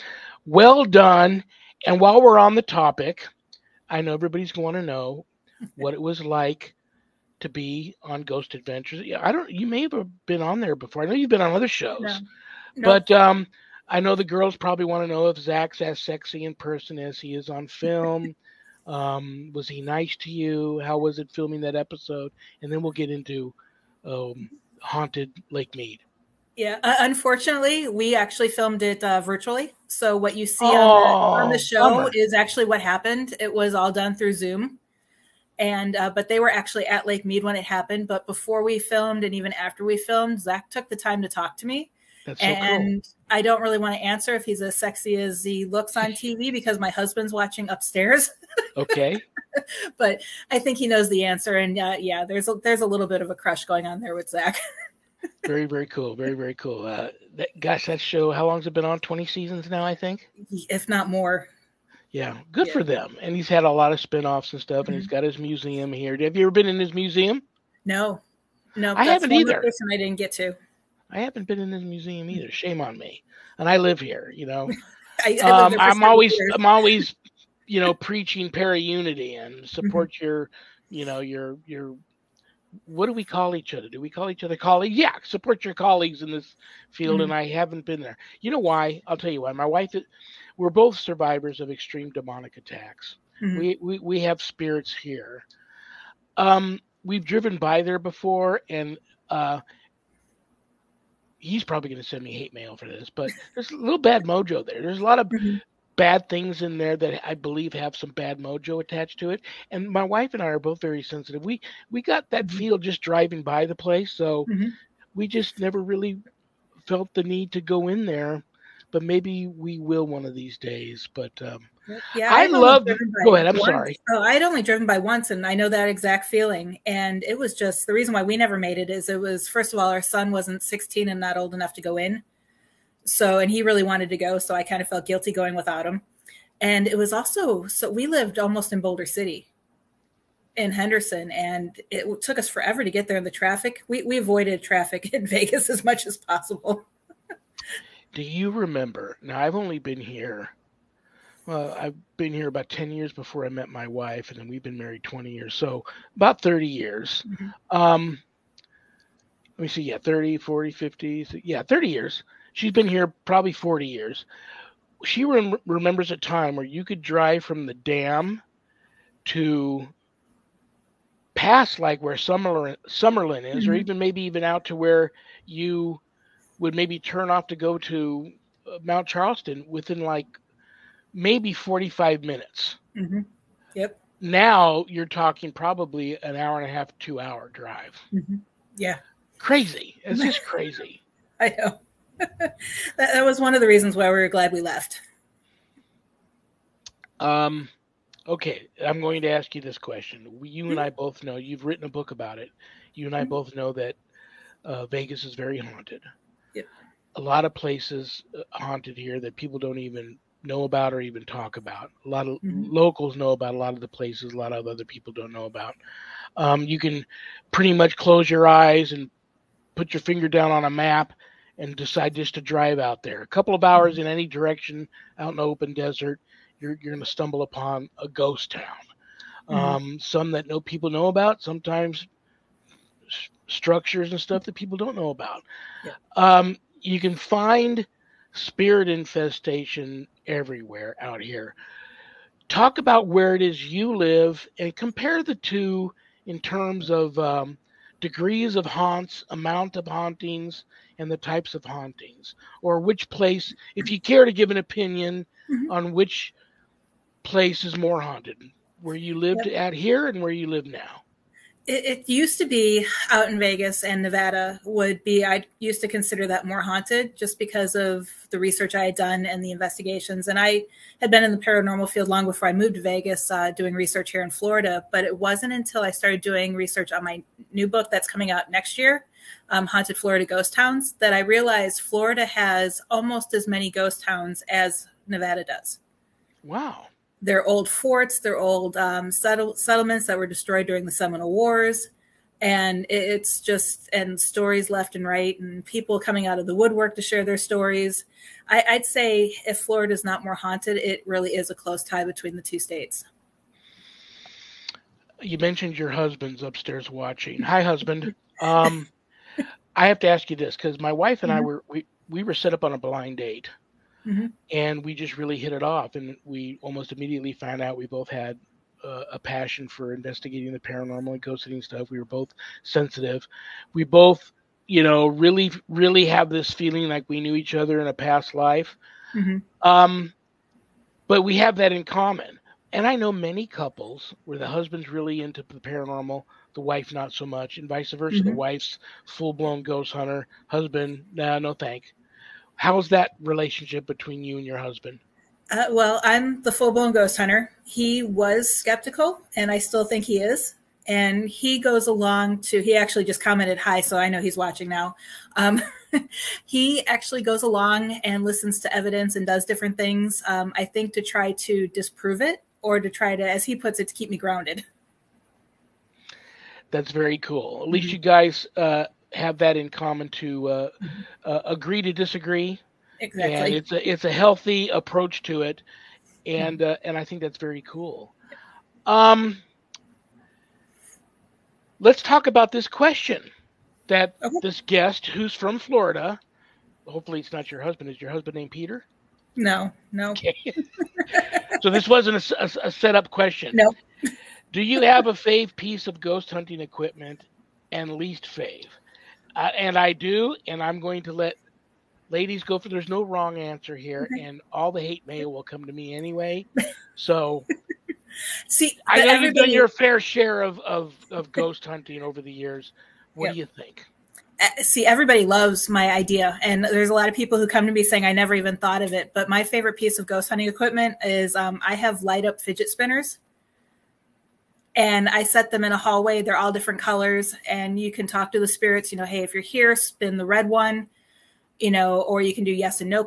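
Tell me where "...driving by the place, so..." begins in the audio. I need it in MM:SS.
01:53.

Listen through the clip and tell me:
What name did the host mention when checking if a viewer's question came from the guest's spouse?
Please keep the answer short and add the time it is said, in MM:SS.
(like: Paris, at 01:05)
Peter, at 06:28.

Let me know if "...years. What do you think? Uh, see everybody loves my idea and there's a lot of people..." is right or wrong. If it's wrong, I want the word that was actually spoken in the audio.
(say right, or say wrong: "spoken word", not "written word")
right.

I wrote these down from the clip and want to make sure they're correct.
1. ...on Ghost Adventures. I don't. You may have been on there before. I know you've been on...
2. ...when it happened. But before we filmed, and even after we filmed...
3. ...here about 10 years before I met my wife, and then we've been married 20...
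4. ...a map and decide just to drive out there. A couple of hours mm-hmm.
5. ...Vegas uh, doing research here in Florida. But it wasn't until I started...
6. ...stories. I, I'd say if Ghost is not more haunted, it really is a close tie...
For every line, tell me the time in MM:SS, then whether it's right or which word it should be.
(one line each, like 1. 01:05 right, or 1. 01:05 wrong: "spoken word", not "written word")
1. 00:08 right
2. 00:37 right
3. 02:32 right
4. 03:40 right
5. 04:32 right
6. 04:57 wrong: "Florida", not "Ghost".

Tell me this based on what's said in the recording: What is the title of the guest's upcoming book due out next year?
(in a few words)
Haunted Florida Ghost Towns.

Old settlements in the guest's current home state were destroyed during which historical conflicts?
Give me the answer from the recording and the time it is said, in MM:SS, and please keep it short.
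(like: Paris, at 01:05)
Seminole Wars, at 04:50.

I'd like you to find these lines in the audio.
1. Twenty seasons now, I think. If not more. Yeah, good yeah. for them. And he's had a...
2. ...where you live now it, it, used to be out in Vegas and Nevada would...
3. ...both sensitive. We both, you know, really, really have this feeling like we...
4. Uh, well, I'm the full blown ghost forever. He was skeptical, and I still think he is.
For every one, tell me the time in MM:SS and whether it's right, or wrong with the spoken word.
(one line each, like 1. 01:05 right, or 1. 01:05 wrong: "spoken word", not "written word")
1. 00:58 right
2. 04:20 right
3. 05:22 right
4. 05:45 wrong: "hunter", not "forever".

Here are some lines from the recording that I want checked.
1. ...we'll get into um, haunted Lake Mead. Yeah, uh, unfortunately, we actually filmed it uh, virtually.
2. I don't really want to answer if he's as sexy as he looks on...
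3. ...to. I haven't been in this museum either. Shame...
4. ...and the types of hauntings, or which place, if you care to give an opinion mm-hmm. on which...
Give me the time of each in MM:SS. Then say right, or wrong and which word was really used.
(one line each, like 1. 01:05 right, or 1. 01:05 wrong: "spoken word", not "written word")
1. 00:22 right
2. 00:43 right
3. 01:10 right
4. 04:10 right.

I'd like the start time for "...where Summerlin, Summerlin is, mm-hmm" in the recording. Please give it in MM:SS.
02:52.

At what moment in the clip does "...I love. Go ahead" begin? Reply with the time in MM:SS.
02:02.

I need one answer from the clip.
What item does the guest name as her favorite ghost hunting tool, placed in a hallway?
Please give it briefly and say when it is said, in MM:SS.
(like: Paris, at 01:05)
light up fidget spinners, at 07:02.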